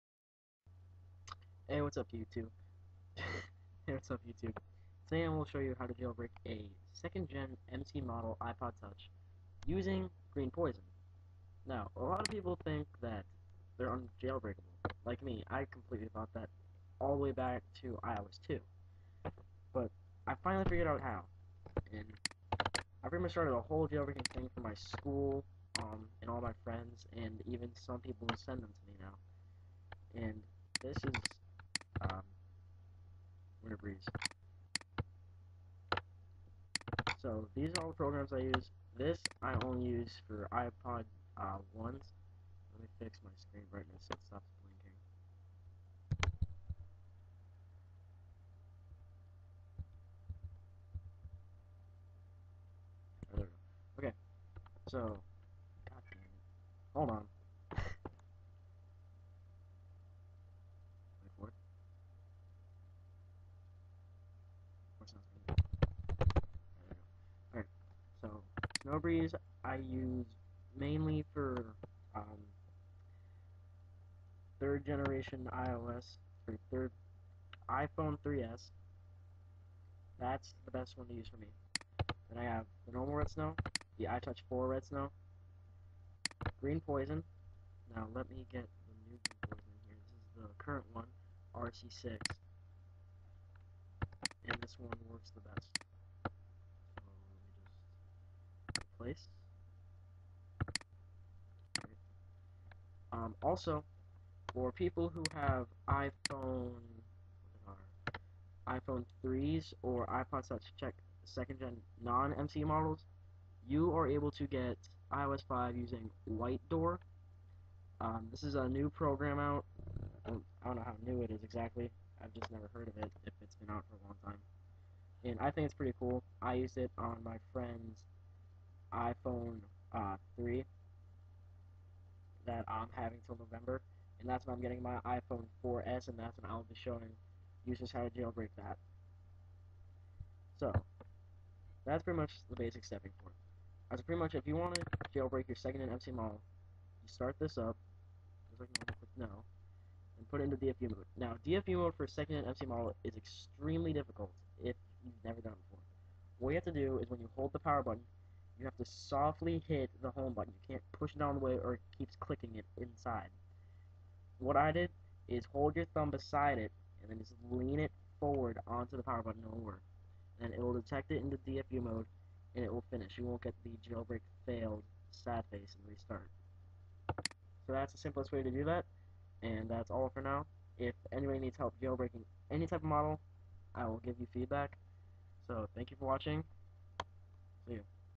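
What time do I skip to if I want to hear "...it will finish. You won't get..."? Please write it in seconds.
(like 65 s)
172 s.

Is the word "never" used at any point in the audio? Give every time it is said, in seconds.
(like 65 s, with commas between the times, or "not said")
122 s, 155 s.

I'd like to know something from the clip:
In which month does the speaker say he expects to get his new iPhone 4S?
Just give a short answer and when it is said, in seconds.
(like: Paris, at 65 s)
November, at 133 s.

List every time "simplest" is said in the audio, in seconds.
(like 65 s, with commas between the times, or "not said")
177 s.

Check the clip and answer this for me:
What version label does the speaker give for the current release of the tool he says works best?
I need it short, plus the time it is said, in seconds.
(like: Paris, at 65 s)
RC6, at 91 s.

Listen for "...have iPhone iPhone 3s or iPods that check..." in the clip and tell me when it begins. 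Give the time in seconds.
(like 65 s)
105 s.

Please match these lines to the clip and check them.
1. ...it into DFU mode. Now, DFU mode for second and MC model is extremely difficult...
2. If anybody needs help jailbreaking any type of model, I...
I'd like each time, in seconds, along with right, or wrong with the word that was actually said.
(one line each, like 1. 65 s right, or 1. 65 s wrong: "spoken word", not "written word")
1. 150 s right
2. 180 s right.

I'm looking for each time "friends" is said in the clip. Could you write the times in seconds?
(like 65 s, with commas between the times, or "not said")
26 s, 127 s.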